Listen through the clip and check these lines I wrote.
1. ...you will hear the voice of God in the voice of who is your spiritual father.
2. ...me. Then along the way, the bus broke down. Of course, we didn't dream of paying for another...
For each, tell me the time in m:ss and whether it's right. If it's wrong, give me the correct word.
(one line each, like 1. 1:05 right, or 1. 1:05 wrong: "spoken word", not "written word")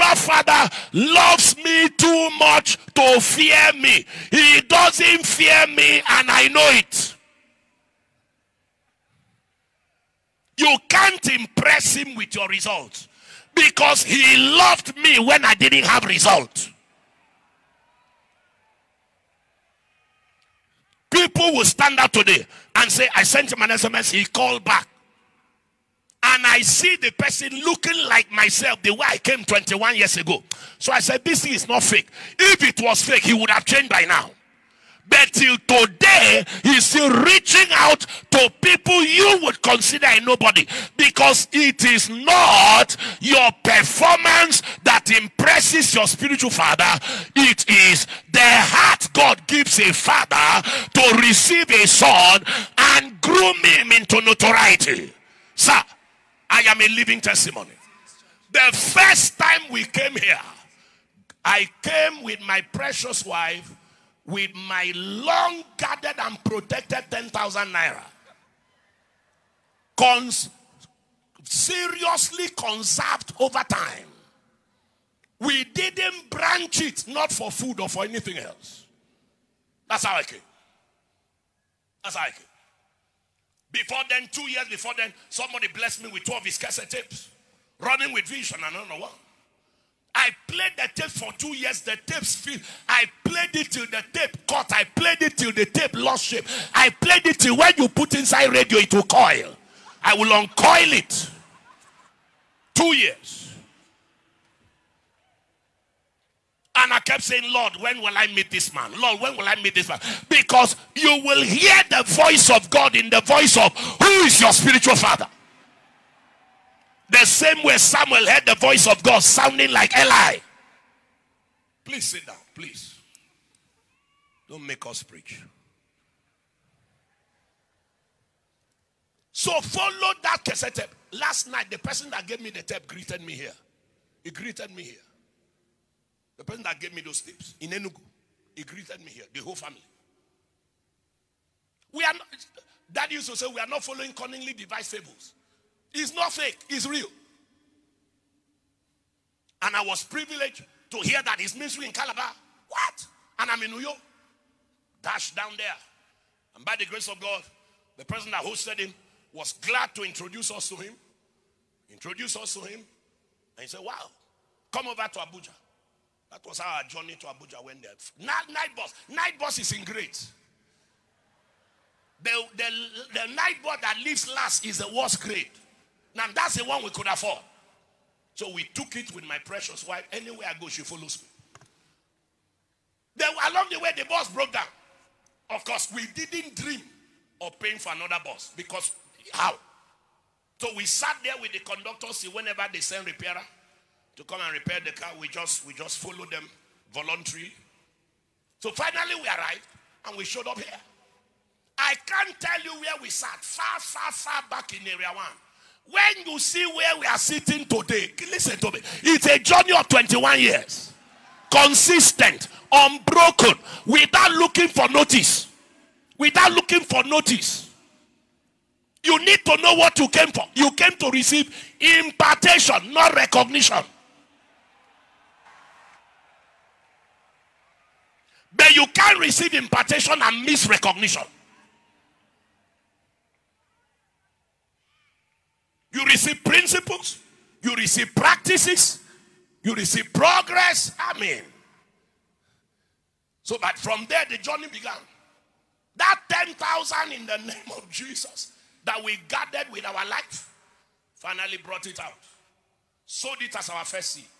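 1. 1:50 right
2. 3:01 right.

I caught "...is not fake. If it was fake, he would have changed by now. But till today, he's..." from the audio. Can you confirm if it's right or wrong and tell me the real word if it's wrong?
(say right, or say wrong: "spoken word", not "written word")
right.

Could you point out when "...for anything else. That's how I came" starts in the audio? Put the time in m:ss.
1:17.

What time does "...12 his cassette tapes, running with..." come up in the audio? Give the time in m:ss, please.
1:26.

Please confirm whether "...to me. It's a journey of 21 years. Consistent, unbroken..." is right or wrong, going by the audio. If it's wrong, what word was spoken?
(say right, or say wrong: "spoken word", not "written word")
right.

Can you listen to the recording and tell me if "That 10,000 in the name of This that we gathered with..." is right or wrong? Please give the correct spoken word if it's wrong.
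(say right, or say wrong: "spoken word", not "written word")
wrong: "Jesus", not "This".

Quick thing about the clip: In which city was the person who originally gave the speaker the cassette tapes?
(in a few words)
Enugu.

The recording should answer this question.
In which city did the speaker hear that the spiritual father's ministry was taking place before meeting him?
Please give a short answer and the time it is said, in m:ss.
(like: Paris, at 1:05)
Calabar, at 2:31.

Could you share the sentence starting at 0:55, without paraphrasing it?
Sir, I am a living testimony.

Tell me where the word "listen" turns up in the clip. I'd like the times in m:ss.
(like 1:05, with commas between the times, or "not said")
3:28.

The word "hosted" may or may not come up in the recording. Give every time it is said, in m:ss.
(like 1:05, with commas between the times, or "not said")
2:38.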